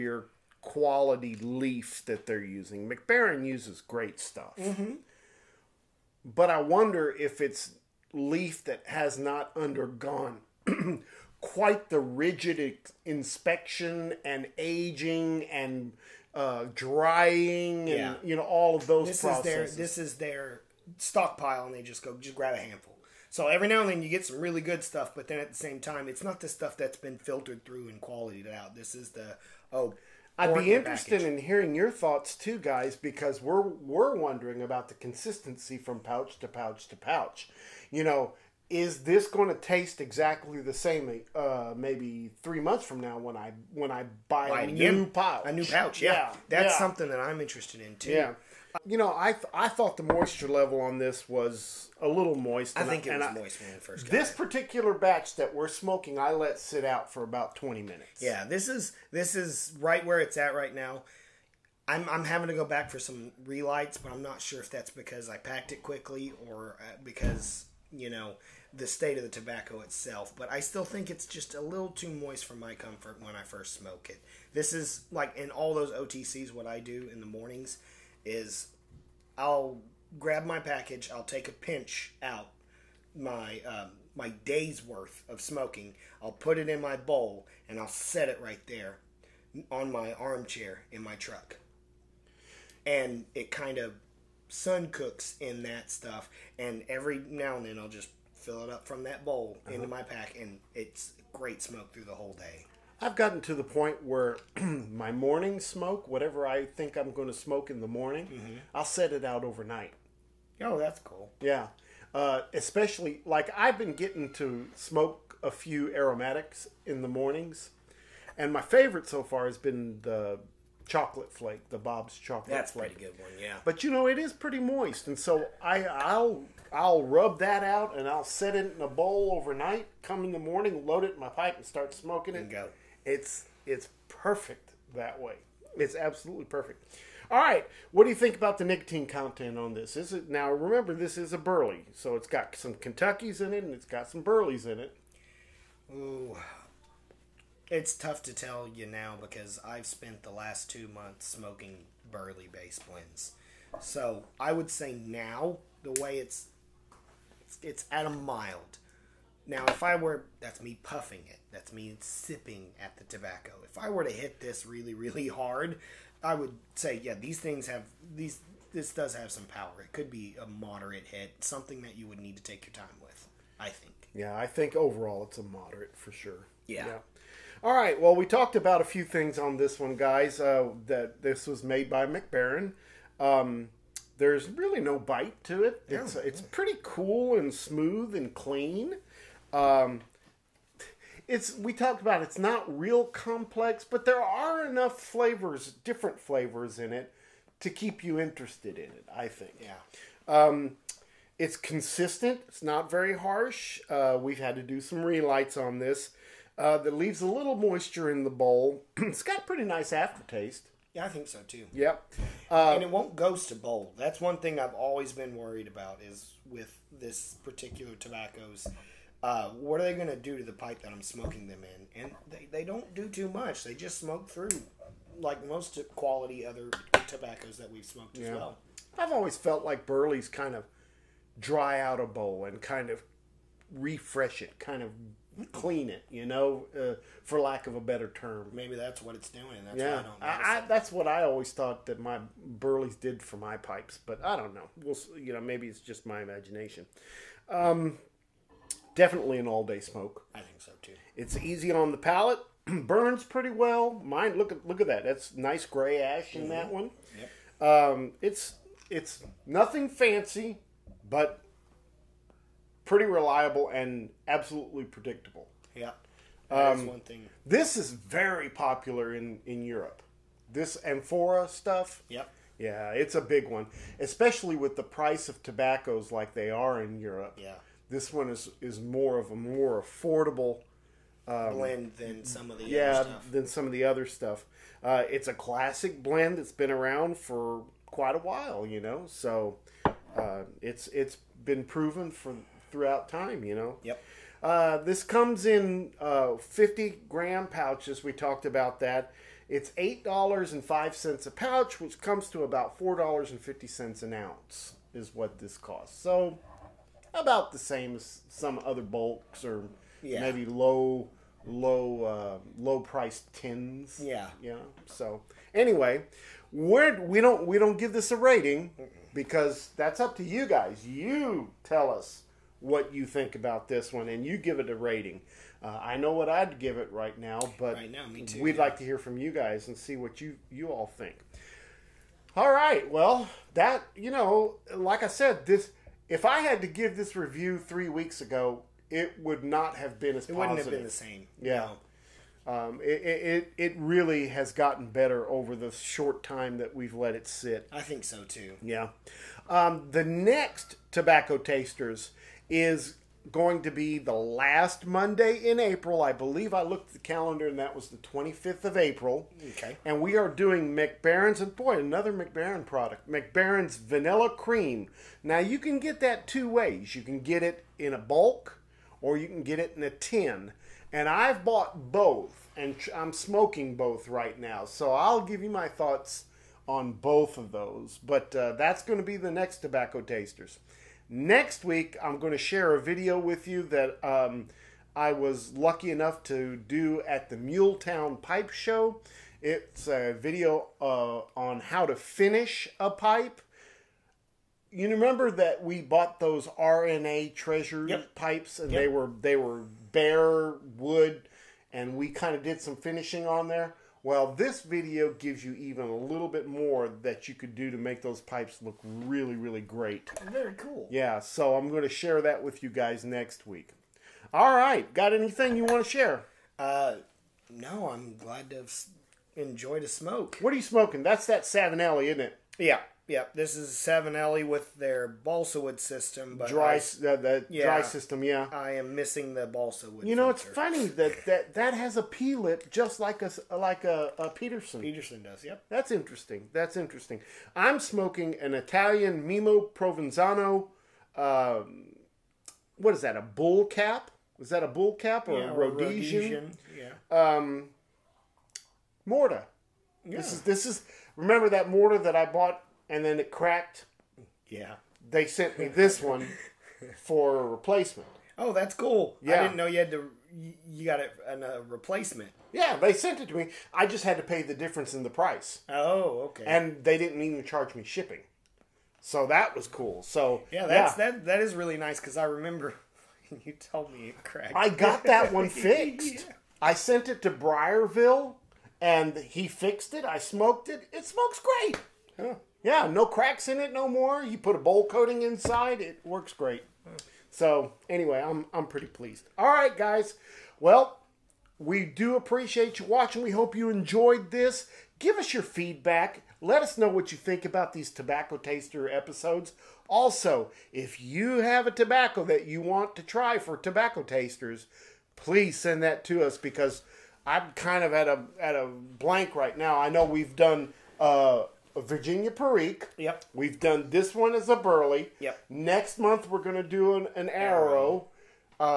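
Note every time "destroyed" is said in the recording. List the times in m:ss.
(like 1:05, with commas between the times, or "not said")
not said.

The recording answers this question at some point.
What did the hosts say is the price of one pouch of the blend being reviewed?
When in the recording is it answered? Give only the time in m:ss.
4:59.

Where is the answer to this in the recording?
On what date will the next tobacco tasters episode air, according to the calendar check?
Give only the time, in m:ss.
5:57.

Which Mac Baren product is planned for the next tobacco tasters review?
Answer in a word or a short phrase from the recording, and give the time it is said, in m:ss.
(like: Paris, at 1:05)
Vanilla Cream, at 6:03.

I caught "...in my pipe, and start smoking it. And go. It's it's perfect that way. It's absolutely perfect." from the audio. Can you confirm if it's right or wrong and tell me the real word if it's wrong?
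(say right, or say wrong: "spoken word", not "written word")
right.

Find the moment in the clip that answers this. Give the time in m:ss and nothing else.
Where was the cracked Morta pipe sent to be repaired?
7:57.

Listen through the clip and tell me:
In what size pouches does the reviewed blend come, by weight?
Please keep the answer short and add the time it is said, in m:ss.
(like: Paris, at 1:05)
50 grams, at 4:56.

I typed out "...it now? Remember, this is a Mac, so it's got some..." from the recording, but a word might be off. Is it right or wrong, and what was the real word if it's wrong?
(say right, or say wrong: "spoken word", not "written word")
wrong: "Burley", not "Mac".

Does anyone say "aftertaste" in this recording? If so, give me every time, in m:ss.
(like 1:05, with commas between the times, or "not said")
3:29.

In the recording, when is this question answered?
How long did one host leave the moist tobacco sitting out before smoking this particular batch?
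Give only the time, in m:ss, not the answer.
0:57.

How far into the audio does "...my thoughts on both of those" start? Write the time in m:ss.
6:15.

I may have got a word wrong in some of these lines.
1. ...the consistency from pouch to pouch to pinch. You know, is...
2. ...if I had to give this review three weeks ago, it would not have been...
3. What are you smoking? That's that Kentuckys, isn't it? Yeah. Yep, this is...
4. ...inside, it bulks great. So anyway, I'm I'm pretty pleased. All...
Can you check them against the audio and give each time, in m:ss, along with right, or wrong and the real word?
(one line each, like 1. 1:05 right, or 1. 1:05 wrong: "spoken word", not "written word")
1. 0:34 wrong: "pouch", not "pinch"
2. 5:36 right
3. 7:00 wrong: "Savinelli", not "Kentuckys"
4. 8:05 wrong: "works", not "bulks".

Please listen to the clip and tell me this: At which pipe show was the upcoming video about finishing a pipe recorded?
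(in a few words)
Muletown Pipe Show.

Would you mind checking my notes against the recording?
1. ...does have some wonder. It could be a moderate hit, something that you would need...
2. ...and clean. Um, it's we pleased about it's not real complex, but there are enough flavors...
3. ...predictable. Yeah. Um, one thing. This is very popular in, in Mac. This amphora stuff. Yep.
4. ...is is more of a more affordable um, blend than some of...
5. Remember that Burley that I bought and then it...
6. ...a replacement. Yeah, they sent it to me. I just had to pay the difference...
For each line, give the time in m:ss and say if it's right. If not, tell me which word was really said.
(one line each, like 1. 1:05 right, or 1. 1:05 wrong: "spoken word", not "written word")
1. 2:48 wrong: "power", not "wonder"
2. 3:08 wrong: "talked", not "pleased"
3. 4:24 wrong: "Europe", not "Mac"
4. 4:38 right
5. 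7:31 wrong: "Morta", not "Burley"
6. 7:41 right.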